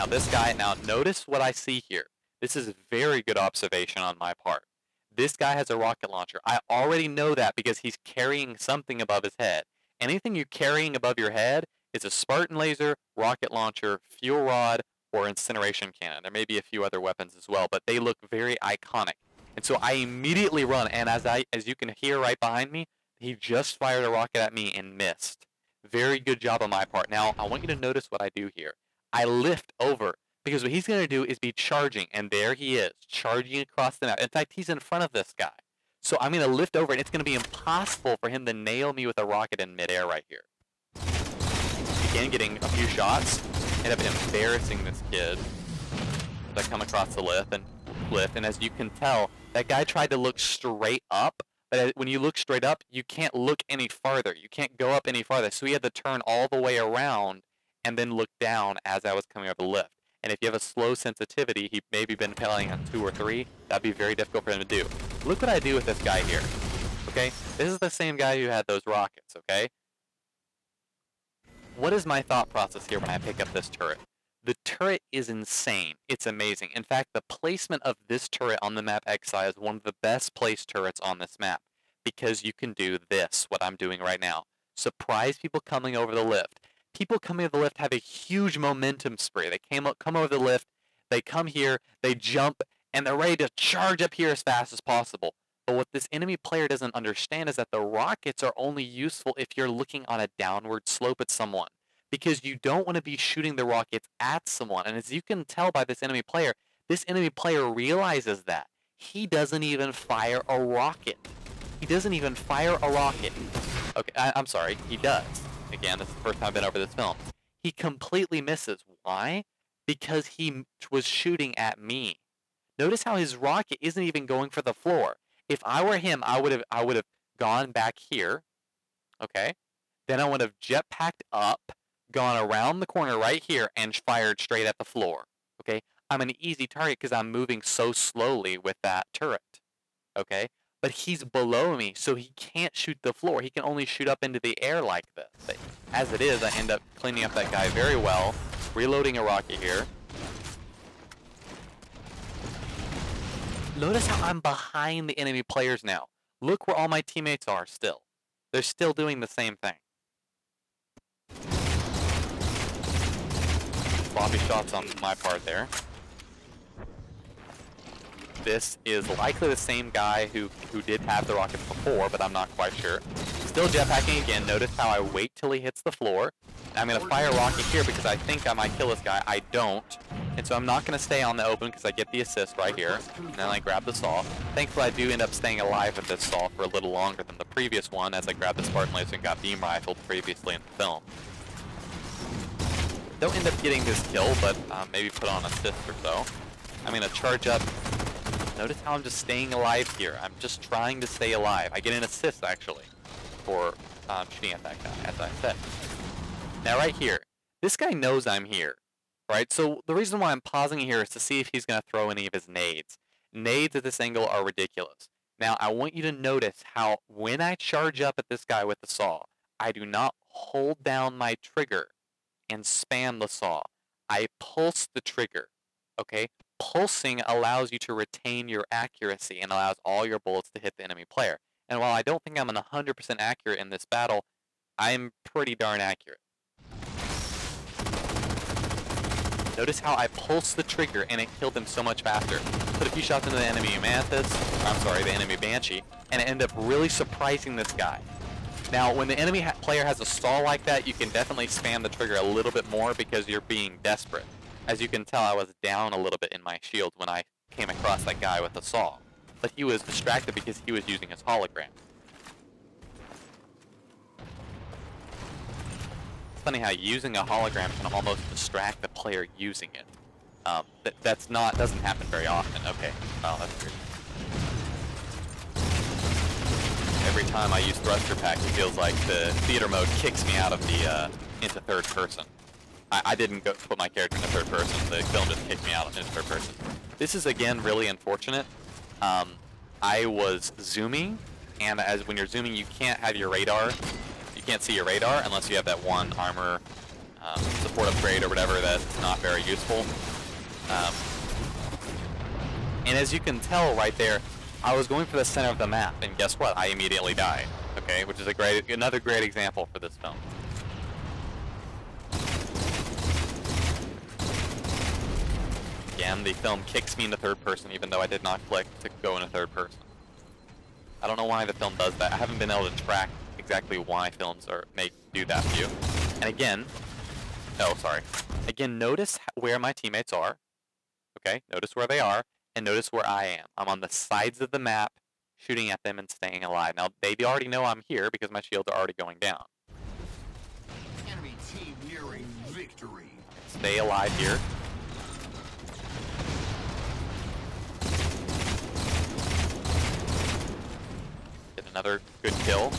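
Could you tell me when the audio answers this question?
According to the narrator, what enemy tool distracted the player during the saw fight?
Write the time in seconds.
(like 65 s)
261 s.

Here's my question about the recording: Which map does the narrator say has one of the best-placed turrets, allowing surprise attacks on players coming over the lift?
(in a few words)
Exile.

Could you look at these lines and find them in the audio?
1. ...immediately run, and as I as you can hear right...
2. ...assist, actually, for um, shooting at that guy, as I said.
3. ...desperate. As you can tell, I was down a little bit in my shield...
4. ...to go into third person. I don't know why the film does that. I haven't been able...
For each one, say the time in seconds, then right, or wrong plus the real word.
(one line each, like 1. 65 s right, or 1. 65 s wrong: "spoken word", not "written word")
1. 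19 s right
2. 202 s right
3. 253 s right
4. 318 s right.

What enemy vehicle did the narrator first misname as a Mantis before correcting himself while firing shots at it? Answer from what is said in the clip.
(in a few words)
Banshee.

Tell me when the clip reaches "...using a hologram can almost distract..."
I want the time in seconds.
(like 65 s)
266 s.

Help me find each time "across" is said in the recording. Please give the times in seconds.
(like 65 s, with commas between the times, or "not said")
33 s, 46 s, 257 s.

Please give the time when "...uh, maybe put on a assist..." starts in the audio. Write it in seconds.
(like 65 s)
194 s.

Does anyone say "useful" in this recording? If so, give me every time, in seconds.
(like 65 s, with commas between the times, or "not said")
98 s, 299 s.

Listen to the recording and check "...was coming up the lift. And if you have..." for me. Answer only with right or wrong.
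right.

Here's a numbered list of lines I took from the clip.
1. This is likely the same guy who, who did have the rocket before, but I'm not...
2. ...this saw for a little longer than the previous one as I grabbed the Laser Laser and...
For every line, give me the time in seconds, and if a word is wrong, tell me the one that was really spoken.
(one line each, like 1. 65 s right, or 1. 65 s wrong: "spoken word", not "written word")
1. 168 s right
2. 186 s wrong: "Spartan", not "Laser".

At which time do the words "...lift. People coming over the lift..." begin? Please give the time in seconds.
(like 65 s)
86 s.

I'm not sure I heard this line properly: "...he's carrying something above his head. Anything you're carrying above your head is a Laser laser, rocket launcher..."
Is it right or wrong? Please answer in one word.
wrong.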